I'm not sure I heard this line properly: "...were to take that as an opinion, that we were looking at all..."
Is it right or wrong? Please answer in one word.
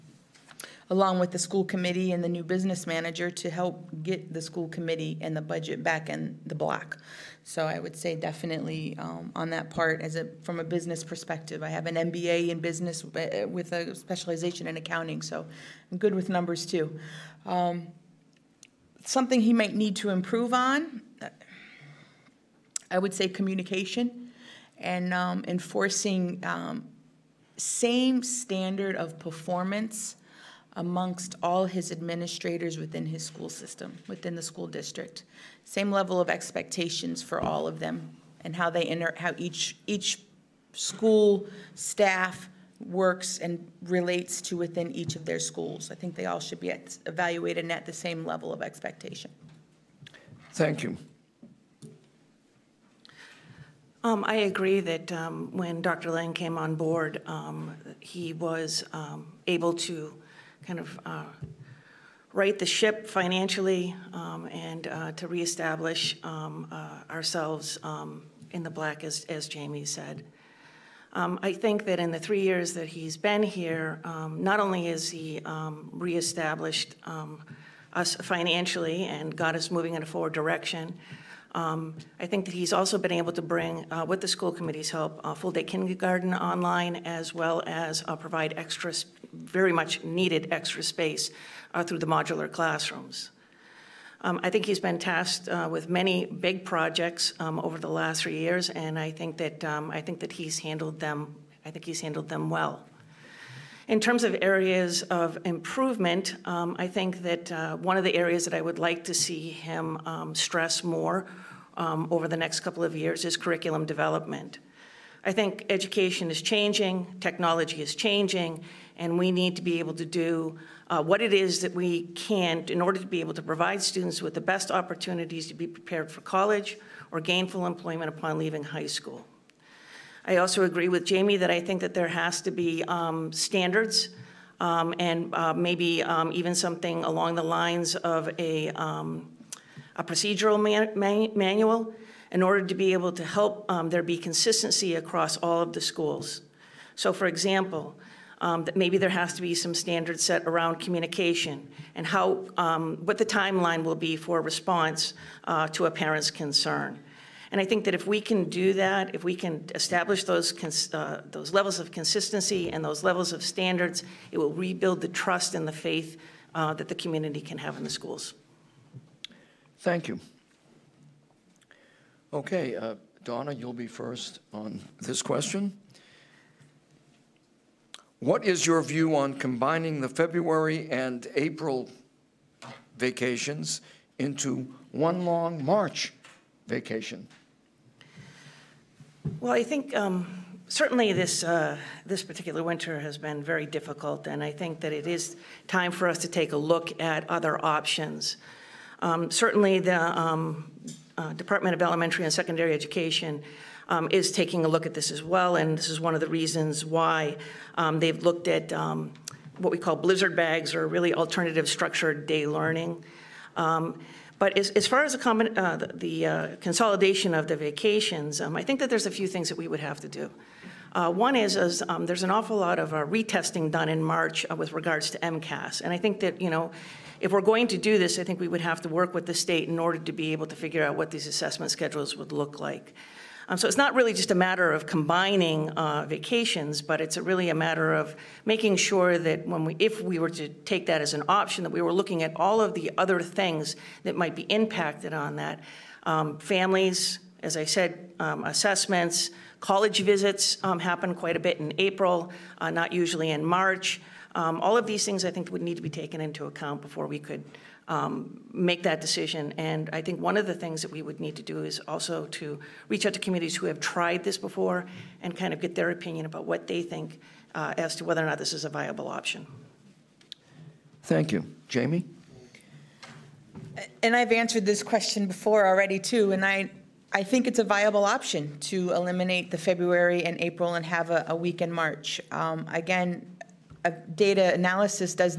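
wrong.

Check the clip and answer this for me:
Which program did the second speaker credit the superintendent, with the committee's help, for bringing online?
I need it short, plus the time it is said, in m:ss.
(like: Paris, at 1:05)
full-day kindergarten, at 1:25.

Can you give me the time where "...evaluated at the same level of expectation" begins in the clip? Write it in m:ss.
0:47.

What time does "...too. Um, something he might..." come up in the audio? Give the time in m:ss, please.
0:16.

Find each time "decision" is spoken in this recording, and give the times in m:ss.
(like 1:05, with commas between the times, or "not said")
4:19.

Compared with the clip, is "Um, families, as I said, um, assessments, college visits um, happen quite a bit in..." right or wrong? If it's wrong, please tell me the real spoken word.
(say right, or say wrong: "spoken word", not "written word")
right.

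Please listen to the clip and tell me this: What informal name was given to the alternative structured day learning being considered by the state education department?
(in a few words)
blizzard bags.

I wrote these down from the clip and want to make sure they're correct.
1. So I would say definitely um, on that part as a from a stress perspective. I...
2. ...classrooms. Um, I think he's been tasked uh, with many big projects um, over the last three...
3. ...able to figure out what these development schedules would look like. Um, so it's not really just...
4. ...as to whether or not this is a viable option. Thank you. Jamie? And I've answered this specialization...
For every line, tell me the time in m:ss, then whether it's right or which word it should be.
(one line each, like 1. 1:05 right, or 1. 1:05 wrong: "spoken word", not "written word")
1. 0:07 wrong: "business", not "stress"
2. 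1:32 right
3. 3:50 wrong: "assessment", not "development"
4. 4:27 wrong: "question", not "specialization".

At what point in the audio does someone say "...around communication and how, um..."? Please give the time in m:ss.
2:30.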